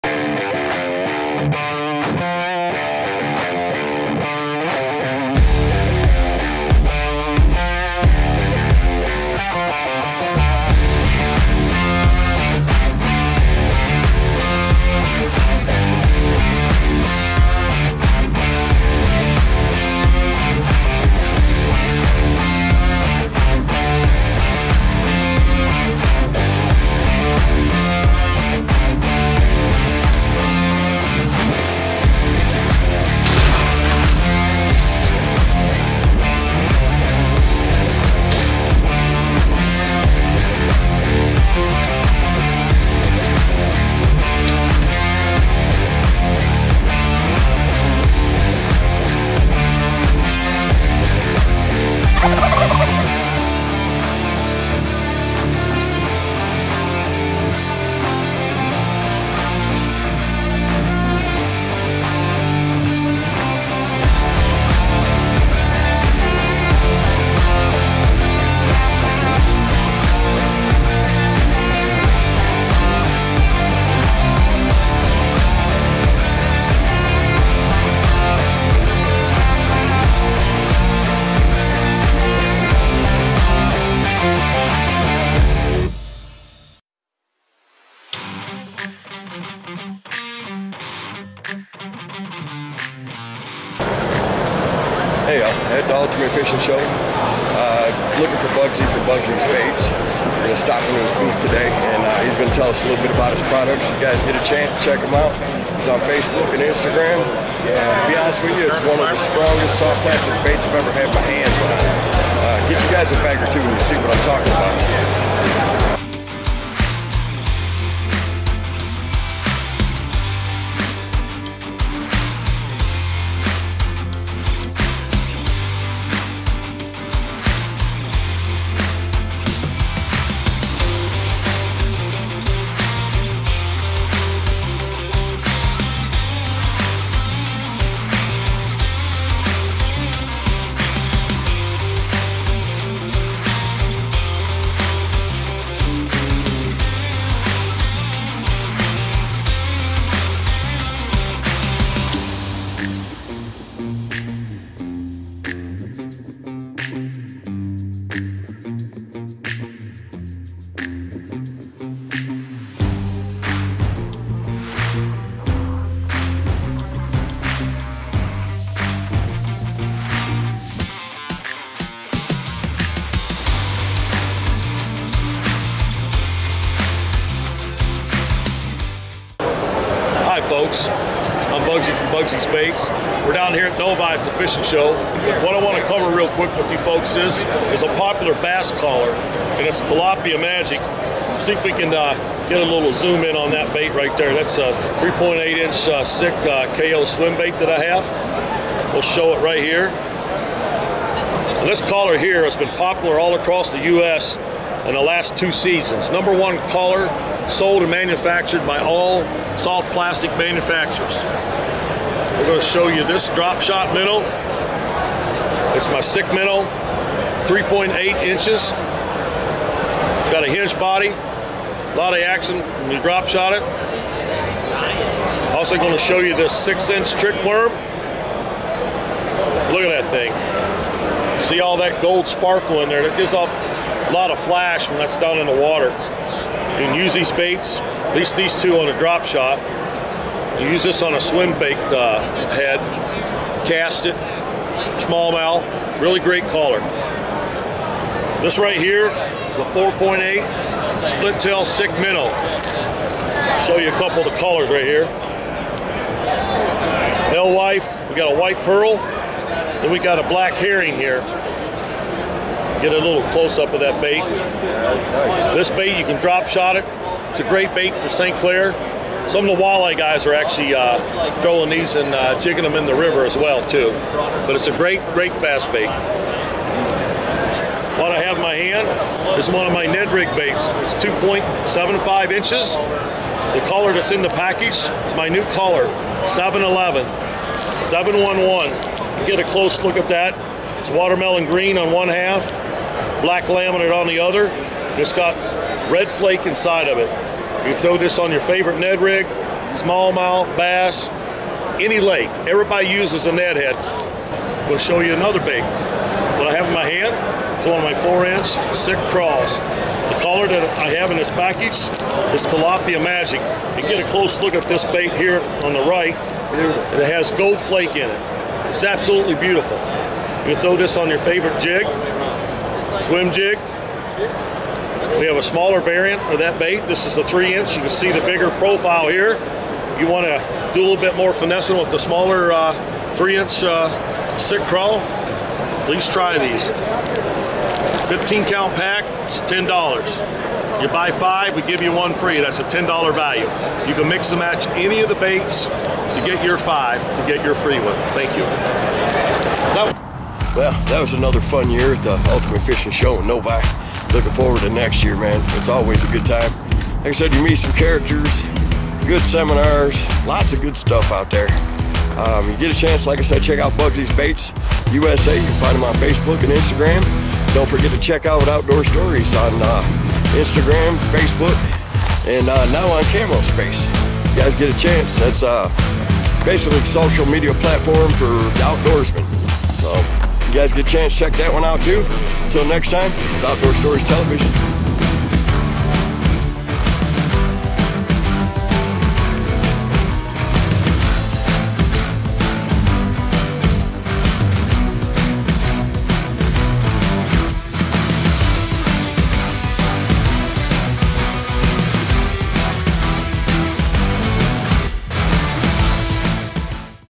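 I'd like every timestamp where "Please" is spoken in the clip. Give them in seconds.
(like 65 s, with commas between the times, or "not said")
335 s.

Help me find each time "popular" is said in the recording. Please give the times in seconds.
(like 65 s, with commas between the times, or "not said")
187 s, 202 s.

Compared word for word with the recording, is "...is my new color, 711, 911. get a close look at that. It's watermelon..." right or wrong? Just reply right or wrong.
wrong.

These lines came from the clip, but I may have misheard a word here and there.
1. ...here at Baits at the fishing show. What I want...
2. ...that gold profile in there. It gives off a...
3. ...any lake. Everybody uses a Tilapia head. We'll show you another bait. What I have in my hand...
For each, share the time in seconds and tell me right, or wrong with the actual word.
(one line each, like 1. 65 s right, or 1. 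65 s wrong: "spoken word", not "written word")
1. 183 s wrong: "Novi", not "Baits"
2. 231 s wrong: "sparkle", not "profile"
3. 301 s wrong: "Ned", not "Tilapia".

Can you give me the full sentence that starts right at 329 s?
You want to do a little bit more finessing with the smaller uh, three inch uh, stick crawl.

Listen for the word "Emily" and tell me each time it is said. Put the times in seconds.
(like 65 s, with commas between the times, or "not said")
not said.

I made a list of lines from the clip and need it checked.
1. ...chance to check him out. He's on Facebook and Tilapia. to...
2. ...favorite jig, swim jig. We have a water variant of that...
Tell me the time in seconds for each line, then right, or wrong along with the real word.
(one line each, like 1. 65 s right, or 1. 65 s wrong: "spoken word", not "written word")
1. 104 s wrong: "Instagram", not "Tilapia"
2. 321 s wrong: "smaller", not "water".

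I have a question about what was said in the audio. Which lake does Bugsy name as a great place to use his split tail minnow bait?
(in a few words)
St. Clair.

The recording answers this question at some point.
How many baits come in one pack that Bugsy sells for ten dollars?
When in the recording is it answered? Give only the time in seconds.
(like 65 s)
338 s.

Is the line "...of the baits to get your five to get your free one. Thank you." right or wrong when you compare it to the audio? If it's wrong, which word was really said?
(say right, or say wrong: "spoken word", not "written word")
right.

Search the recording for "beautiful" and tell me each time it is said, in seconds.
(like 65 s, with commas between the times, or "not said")
319 s.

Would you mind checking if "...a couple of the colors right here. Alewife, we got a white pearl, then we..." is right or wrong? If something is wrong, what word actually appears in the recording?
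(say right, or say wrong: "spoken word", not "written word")
right.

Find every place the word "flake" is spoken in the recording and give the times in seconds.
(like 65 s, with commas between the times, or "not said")
296 s, 317 s.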